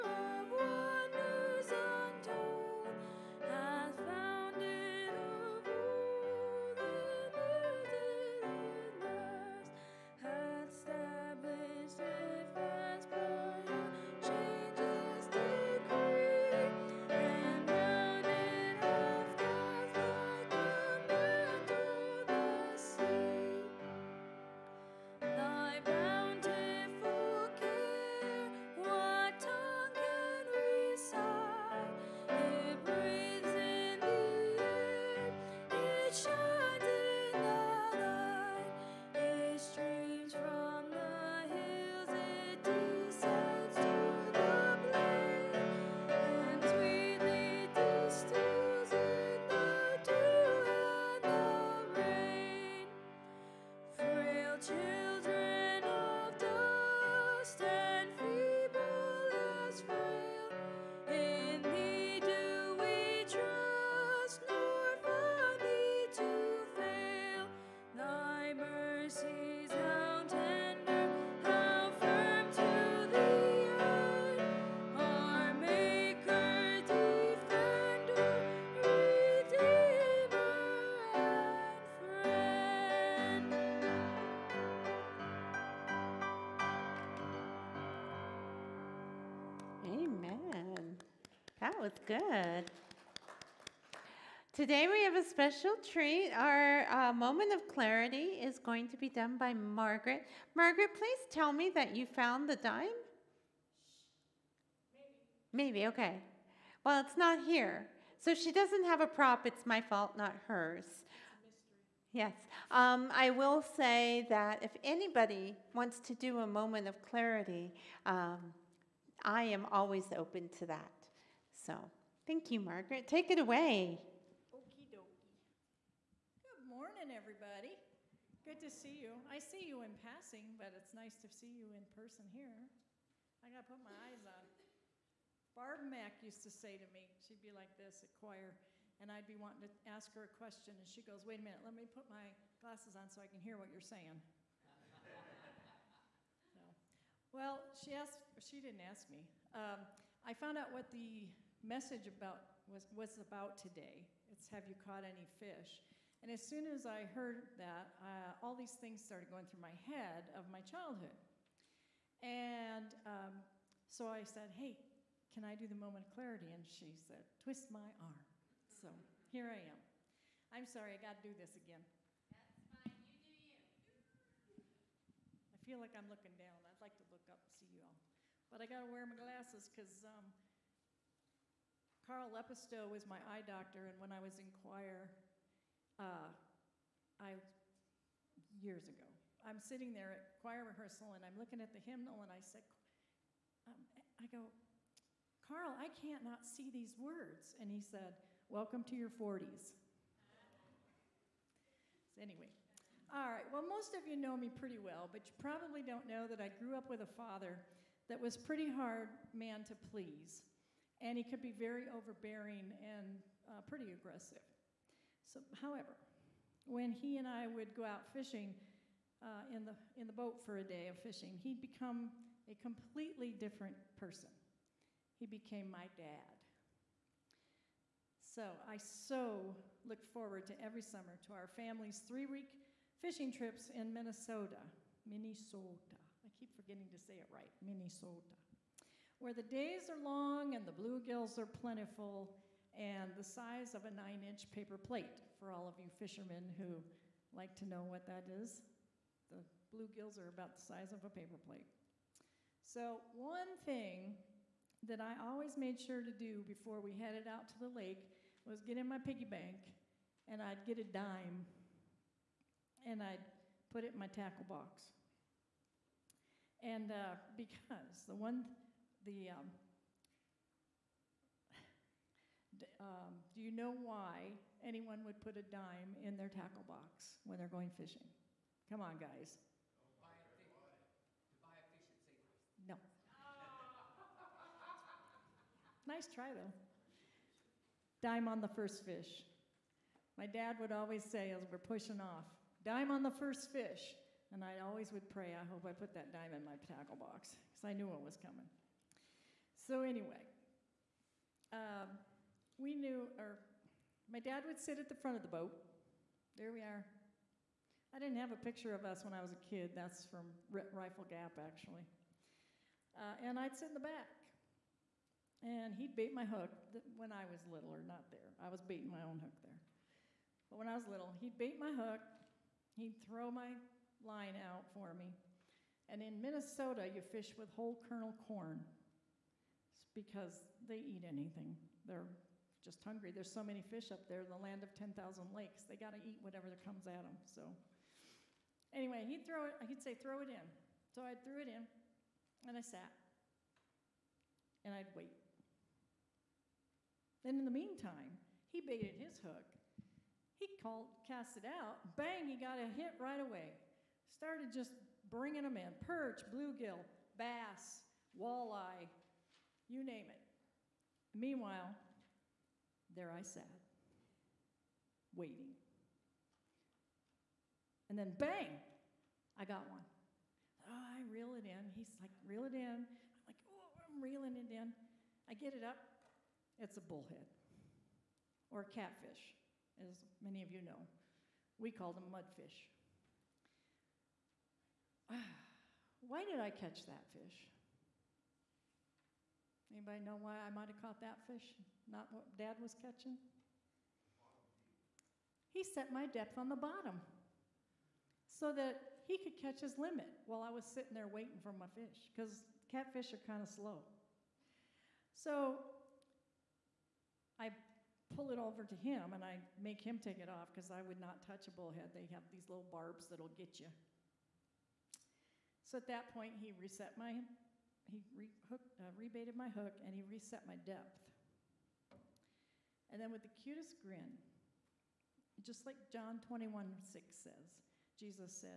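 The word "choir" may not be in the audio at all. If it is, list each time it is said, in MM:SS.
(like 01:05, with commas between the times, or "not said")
02:18, 03:04, 03:10.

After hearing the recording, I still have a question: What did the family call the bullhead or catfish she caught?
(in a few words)
Mudfish.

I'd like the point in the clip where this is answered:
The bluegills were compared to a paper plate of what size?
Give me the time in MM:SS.
04:03.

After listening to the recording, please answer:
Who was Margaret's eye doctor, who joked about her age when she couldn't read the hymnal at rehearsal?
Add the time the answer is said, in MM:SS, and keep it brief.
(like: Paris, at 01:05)
Carl Lepisto, at 03:02.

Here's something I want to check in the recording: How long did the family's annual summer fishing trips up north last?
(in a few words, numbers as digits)
3 weeks.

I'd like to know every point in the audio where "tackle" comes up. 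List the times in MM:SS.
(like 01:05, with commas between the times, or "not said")
04:24, 04:36, 04:56.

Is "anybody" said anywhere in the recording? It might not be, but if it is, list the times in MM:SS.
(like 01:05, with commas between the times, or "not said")
01:54, 06:29.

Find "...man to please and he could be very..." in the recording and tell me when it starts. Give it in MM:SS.
03:29.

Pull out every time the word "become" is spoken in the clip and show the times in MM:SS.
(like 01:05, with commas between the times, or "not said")
03:41.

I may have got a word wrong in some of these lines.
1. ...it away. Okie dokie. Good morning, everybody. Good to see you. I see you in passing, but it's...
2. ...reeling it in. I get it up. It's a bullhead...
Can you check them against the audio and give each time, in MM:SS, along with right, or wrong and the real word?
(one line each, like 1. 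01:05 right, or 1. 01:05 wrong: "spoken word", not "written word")
1. 02:03 right
2. 06:14 right.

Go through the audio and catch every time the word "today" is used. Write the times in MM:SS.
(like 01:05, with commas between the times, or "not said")
01:34, 02:33.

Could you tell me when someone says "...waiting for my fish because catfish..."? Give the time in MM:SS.
06:41.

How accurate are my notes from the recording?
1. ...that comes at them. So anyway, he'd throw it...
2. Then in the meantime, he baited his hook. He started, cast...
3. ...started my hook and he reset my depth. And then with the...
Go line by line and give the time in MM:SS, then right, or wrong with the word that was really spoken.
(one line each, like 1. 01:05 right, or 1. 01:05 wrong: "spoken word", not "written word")
1. 05:36 right
2. 05:47 wrong: "called", not "started"
3. 06:58 wrong: "rebaited", not "started".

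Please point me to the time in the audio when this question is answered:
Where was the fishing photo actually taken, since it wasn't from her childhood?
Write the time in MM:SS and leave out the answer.
05:10.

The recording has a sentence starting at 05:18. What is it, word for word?
I was baiting my own hook there.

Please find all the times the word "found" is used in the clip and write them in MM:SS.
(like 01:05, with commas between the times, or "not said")
01:42, 02:30.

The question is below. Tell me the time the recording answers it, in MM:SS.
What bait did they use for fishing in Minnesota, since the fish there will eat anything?
05:27.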